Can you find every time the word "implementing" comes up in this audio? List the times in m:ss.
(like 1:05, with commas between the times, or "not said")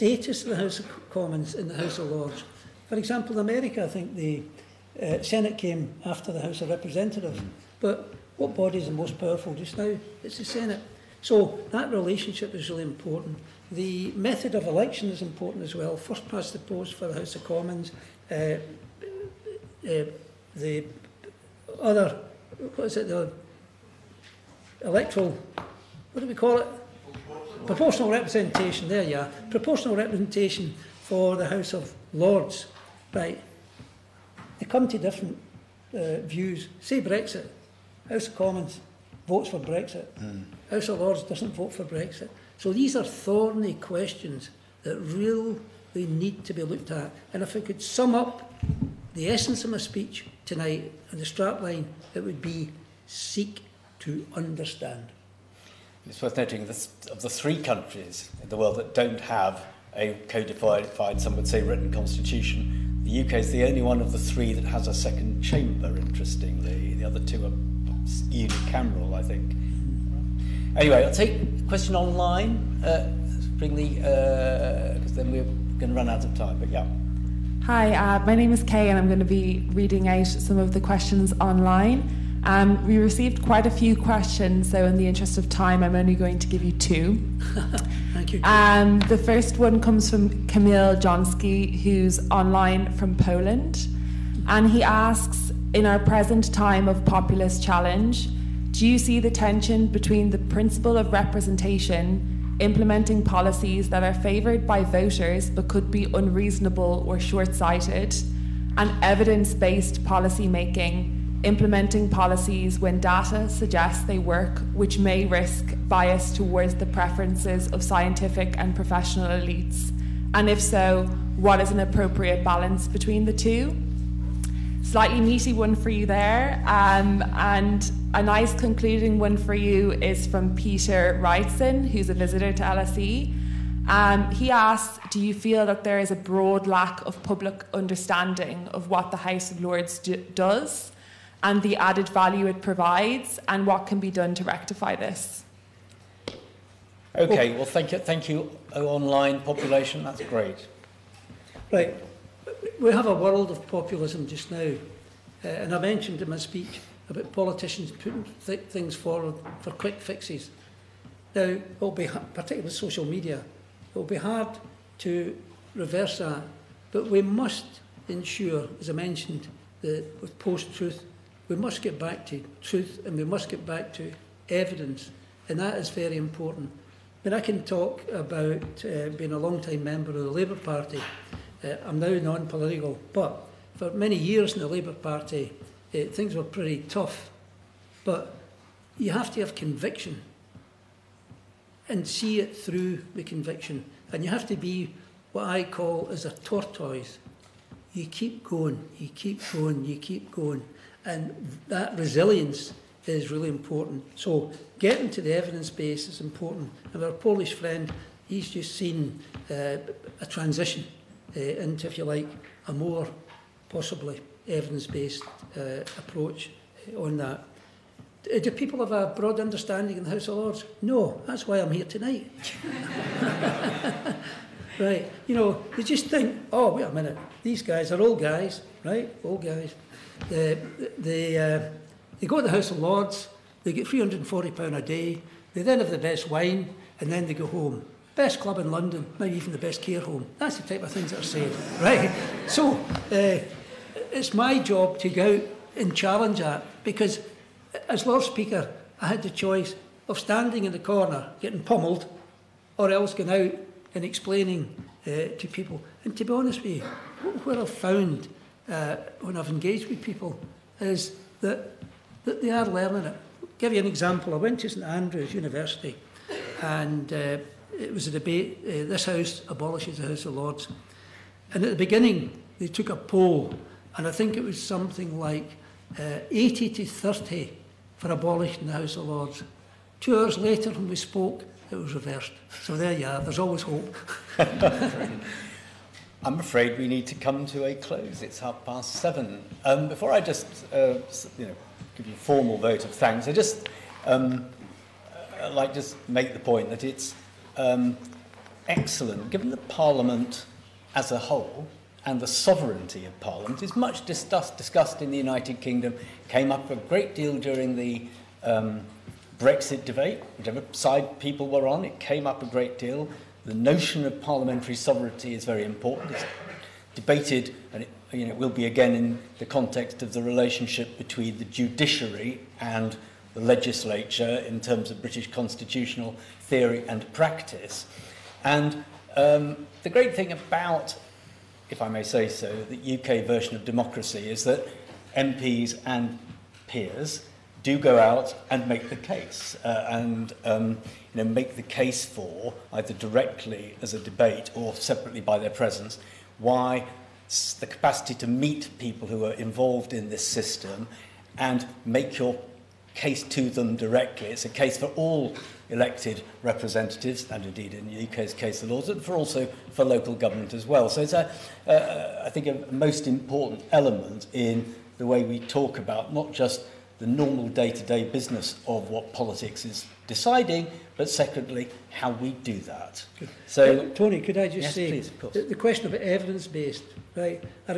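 1:42, 1:51.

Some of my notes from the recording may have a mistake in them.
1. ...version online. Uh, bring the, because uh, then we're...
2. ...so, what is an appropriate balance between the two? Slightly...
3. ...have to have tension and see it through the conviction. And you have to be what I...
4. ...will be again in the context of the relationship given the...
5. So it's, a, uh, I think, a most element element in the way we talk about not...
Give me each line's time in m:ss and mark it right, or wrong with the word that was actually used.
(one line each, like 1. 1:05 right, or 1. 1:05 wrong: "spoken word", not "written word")
1. 1:11 wrong: "question", not "version"
2. 2:00 right
3. 3:09 wrong: "conviction", not "tension"
4. 5:18 wrong: "between", not "given"
5. 6:00 wrong: "important", not "element".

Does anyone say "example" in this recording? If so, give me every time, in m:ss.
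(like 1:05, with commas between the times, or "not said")
0:02, 4:23.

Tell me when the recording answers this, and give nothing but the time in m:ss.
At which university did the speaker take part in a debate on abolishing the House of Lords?
4:24.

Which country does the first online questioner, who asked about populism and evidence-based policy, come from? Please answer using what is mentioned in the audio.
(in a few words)
Poland.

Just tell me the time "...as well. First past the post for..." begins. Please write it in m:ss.
0:15.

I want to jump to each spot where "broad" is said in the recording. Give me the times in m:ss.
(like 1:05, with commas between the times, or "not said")
2:16, 3:39.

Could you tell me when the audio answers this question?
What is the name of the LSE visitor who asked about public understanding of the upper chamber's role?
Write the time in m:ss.
2:10.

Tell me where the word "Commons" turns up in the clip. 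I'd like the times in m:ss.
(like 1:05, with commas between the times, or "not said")
0:01, 0:17, 0:38.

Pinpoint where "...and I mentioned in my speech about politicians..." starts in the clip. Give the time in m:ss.
2:35.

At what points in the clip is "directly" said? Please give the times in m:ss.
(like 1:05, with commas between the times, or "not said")
5:42, 5:53.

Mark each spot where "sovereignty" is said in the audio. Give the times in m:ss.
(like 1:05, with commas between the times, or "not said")
5:02, 5:14.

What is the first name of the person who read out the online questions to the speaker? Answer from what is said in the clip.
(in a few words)
Kay.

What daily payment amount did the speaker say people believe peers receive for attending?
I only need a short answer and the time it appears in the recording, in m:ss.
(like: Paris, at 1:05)
£340, at 3:53.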